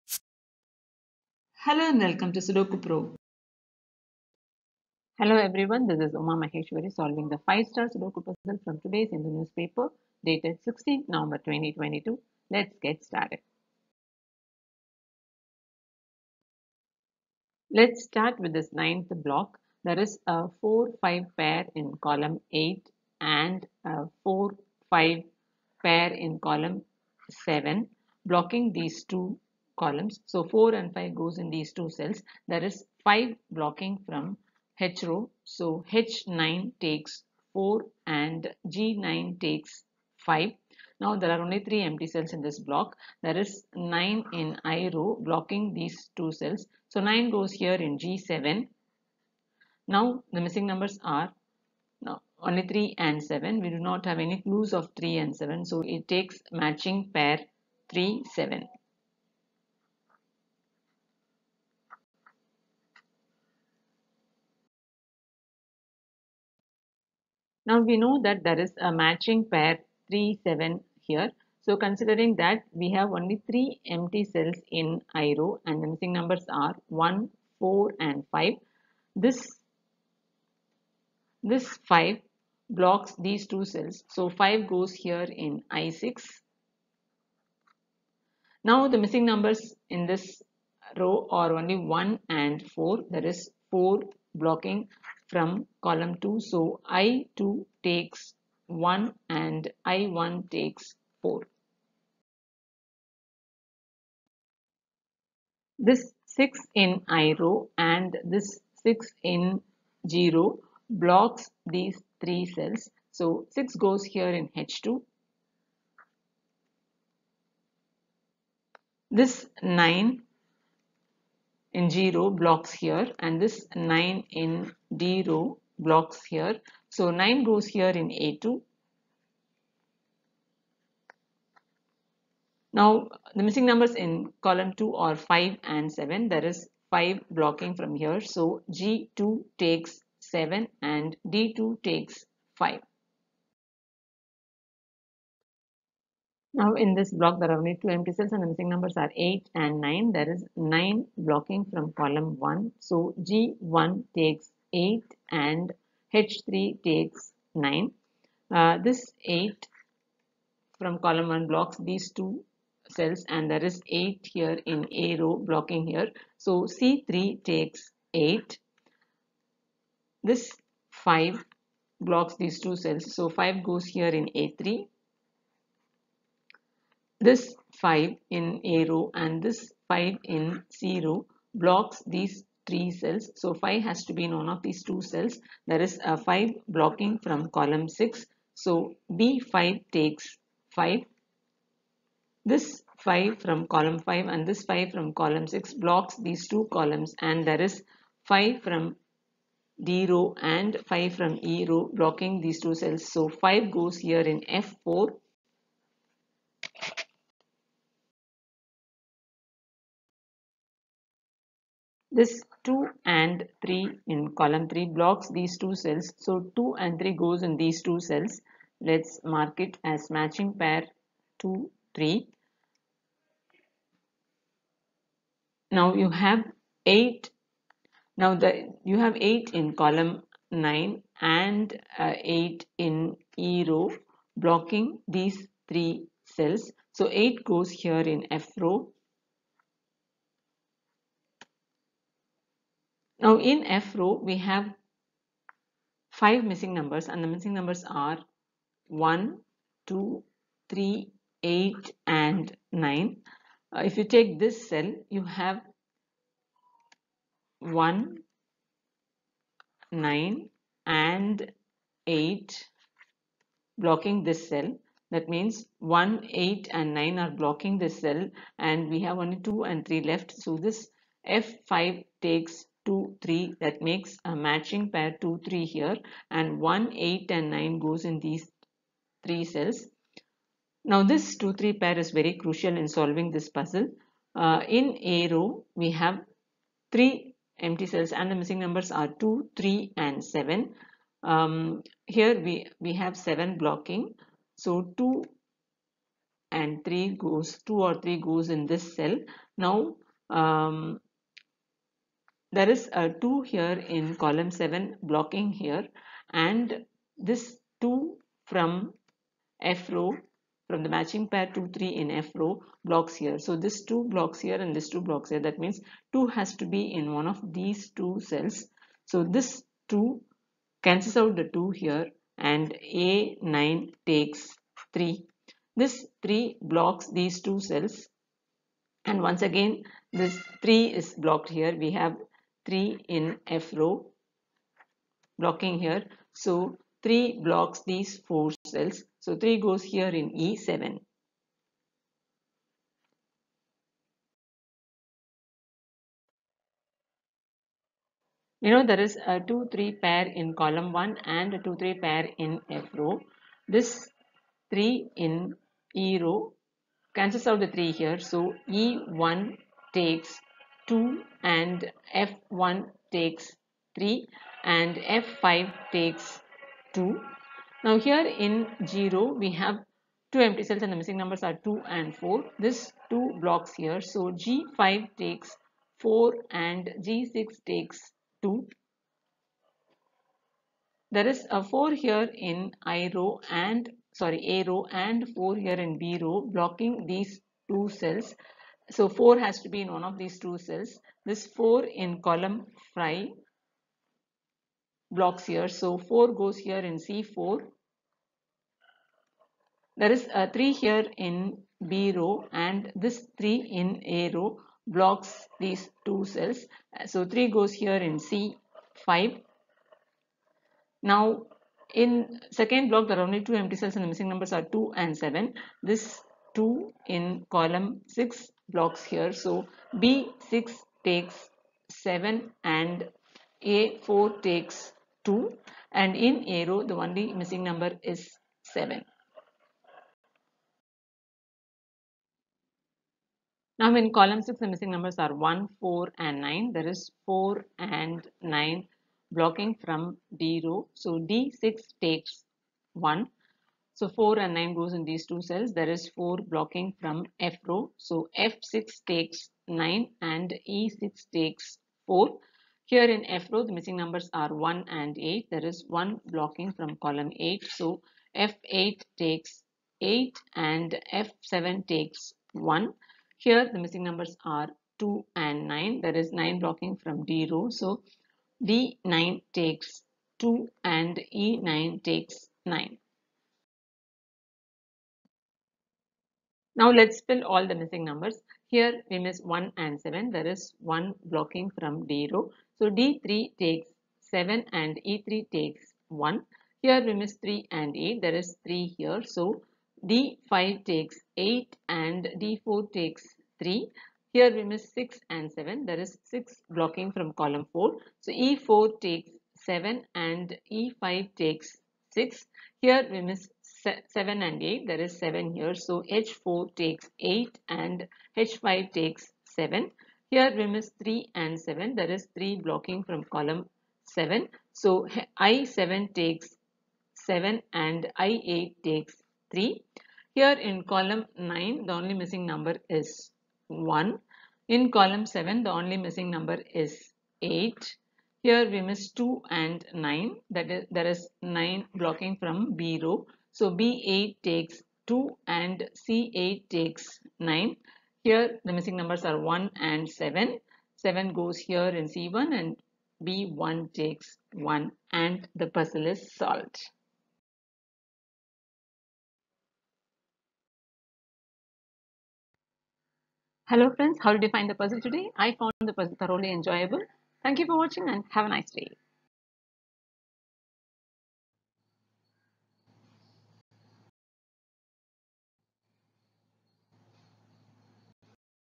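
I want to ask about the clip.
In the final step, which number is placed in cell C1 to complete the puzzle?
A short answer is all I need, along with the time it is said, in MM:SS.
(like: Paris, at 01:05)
7, at 09:00.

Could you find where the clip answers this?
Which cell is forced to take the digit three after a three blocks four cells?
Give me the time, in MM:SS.
05:40.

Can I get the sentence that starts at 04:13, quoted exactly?
Uh, if you take this cell, you have 1, 9 and 8 blocking this cell.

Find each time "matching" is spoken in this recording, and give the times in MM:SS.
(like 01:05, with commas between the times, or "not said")
00:56, 01:08, 03:40, 04:34, 05:10.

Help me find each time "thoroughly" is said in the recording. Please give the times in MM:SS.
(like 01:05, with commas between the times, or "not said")
09:16.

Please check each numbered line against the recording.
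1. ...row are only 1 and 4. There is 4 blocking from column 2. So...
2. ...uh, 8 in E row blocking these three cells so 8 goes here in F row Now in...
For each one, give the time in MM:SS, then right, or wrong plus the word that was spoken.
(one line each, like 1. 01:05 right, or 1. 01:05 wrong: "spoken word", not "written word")
1. 01:30 right
2. 03:51 right.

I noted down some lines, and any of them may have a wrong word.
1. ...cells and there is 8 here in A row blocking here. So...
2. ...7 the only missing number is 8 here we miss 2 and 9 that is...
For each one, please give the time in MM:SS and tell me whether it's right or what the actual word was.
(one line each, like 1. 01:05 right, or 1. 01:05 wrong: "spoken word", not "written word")
1. 02:42 right
2. 08:45 right.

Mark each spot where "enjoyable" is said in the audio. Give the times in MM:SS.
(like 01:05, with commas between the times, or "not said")
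09:16.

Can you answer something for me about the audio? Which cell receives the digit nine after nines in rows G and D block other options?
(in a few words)
A2.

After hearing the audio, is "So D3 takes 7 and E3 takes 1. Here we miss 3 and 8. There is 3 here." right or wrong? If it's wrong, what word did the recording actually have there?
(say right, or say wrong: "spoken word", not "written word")
right.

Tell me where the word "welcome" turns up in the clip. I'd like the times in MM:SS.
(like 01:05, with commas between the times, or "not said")
00:01.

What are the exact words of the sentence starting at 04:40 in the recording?
Now this 2, 3 pair is very crucial in solving this puzzle.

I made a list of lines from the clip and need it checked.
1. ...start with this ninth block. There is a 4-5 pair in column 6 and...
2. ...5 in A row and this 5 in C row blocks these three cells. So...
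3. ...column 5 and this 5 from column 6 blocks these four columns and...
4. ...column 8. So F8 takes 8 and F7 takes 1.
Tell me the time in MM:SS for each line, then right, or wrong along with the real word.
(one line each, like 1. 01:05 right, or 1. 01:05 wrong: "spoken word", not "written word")
1. 00:18 wrong: "8", not "6"
2. 02:57 right
3. 03:13 wrong: "two", not "four"
4. 07:36 right.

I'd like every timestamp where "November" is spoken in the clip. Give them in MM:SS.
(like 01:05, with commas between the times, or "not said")
00:11.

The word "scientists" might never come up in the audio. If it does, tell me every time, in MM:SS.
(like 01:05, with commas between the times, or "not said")
not said.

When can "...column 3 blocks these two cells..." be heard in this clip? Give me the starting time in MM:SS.
03:34.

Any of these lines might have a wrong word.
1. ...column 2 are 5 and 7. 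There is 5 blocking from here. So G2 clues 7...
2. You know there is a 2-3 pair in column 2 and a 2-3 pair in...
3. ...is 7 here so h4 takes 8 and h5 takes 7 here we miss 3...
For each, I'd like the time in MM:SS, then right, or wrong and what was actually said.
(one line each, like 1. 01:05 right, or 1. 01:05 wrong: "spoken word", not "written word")
1. 02:14 wrong: "takes", not "clues"
2. 05:48 wrong: "1", not "2"
3. 08:25 right.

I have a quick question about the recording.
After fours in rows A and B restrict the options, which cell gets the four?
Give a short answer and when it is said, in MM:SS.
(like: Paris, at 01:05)
C4, at 06:36.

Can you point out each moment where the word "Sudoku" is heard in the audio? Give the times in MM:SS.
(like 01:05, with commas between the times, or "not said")
00:02, 00:07.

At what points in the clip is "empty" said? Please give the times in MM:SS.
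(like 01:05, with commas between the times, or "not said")
00:41, 01:13, 02:27, 04:47, 06:10, 06:53.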